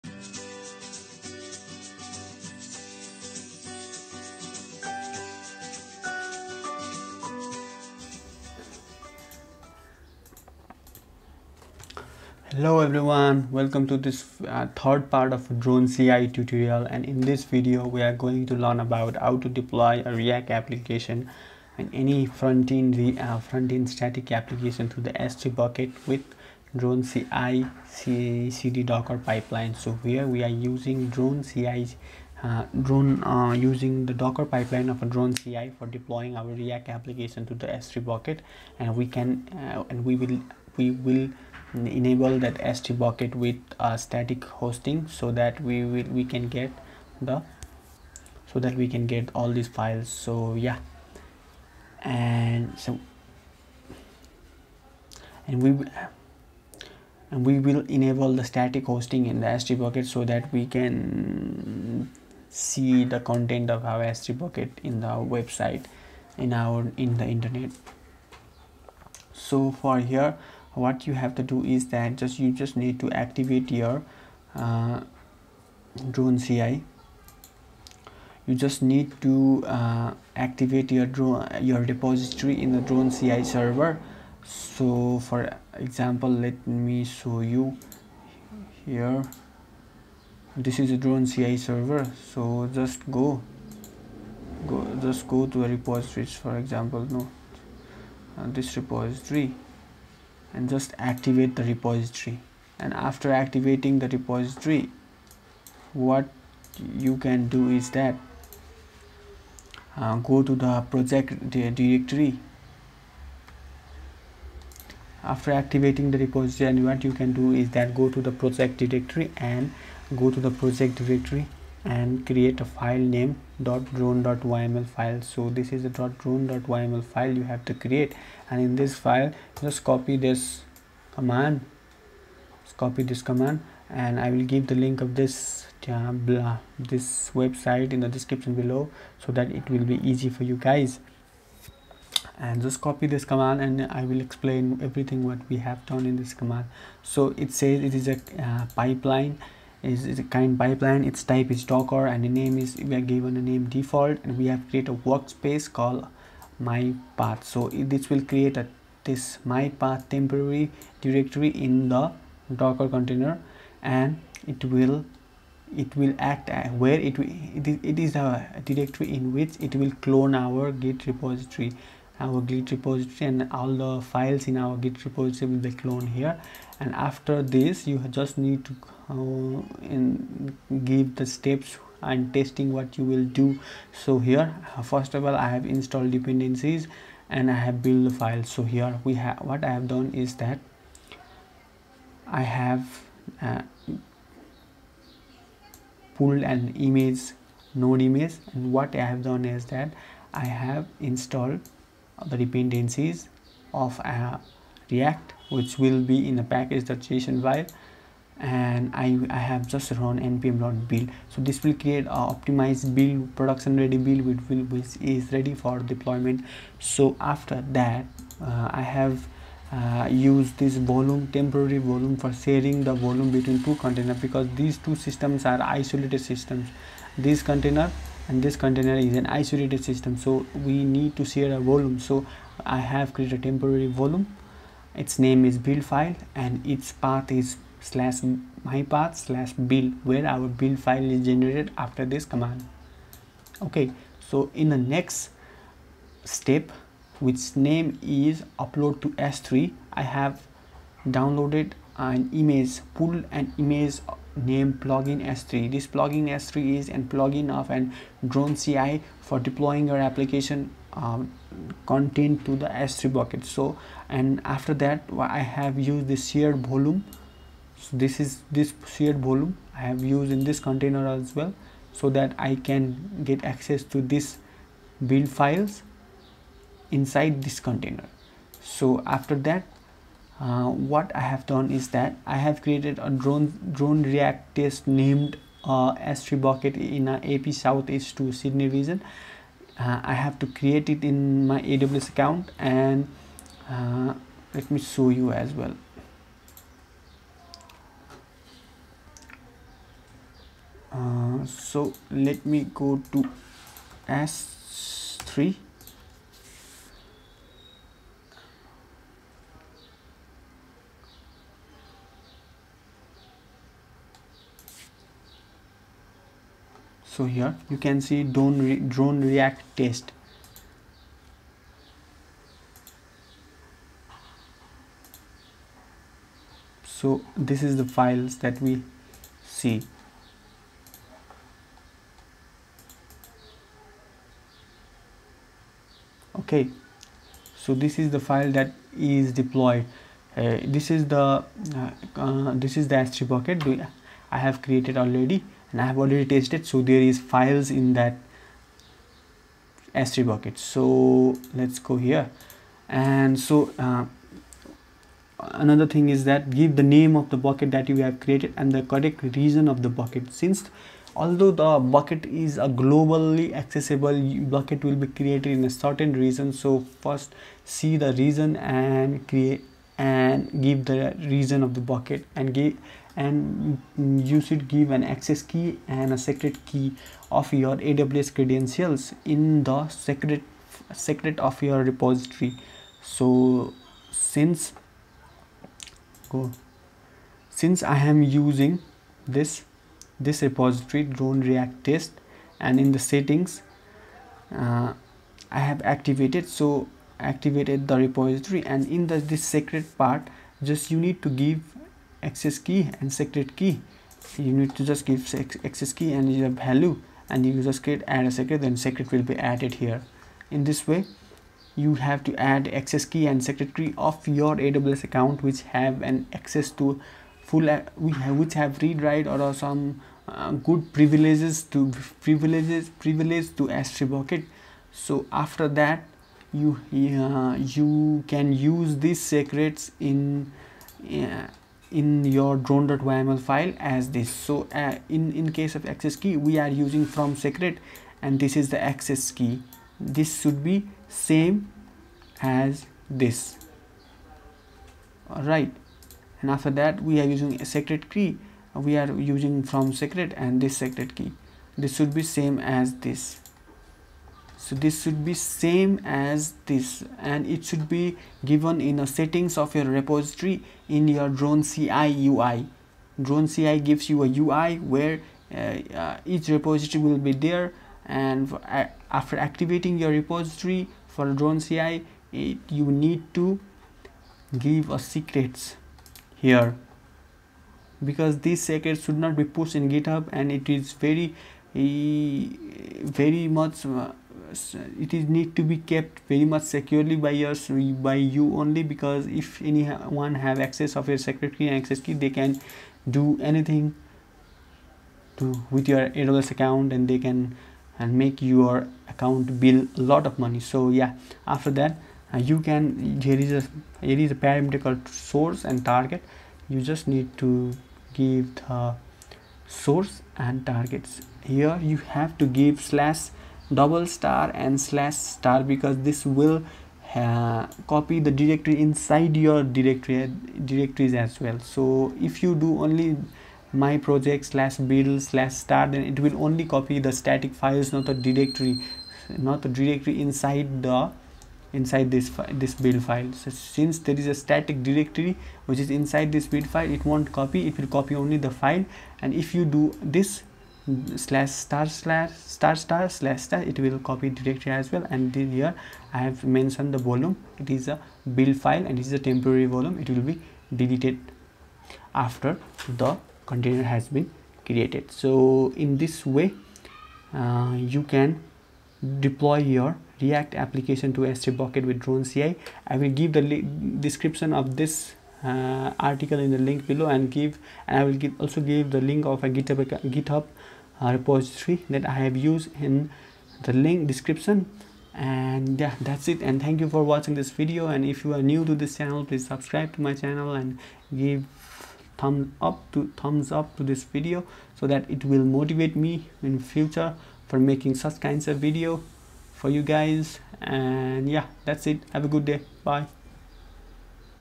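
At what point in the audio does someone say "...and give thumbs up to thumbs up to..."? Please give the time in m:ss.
9:40.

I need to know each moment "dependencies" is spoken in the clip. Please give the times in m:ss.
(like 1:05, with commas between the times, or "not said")
3:06, 3:22.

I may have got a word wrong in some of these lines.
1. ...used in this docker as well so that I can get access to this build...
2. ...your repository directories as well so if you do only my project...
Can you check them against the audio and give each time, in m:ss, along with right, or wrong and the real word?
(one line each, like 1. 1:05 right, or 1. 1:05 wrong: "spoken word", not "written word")
1. 4:30 wrong: "container", not "docker"
2. 8:39 wrong: "directory", not "repository".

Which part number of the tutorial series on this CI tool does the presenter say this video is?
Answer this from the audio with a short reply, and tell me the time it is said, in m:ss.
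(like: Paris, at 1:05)
Third, at 0:14.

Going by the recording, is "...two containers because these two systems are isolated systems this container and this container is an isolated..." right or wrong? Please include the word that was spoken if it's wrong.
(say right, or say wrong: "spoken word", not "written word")
right.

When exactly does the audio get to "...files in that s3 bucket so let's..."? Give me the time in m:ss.
5:47.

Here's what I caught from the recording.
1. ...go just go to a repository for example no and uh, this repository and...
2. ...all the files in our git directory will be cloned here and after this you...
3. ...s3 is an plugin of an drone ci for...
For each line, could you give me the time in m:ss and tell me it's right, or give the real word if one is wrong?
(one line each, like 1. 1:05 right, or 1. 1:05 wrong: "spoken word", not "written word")
1. 1:34 right
2. 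2:53 wrong: "repository", not "directory"
3. 4:16 right.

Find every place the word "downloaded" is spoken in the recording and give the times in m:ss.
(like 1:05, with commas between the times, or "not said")
4:11.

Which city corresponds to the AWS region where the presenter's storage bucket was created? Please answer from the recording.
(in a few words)
Sydney.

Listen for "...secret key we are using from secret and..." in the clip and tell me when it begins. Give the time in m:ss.
7:27.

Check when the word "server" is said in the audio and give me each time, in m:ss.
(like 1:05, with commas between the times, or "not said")
1:23, 1:31.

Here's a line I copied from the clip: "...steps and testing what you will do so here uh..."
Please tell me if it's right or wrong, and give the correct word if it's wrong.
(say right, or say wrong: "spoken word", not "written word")
right.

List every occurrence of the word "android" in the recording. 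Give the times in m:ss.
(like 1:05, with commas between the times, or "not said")
not said.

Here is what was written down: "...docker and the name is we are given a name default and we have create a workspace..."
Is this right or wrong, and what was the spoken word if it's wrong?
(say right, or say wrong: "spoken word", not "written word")
right.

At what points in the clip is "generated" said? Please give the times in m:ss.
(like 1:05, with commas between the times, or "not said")
4:01.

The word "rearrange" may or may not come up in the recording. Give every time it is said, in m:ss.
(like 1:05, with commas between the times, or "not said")
not said.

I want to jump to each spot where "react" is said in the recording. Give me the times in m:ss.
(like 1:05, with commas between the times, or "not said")
0:20, 0:36, 3:24, 4:44, 5:19, 6:31, 9:20.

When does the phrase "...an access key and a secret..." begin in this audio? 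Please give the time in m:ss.
6:14.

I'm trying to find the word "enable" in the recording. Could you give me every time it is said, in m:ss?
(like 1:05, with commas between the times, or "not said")
0:41, 0:57.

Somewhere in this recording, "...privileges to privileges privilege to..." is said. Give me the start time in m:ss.
7:00.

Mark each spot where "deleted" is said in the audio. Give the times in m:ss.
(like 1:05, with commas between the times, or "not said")
9:10.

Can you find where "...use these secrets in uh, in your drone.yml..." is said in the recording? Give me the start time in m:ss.
7:08.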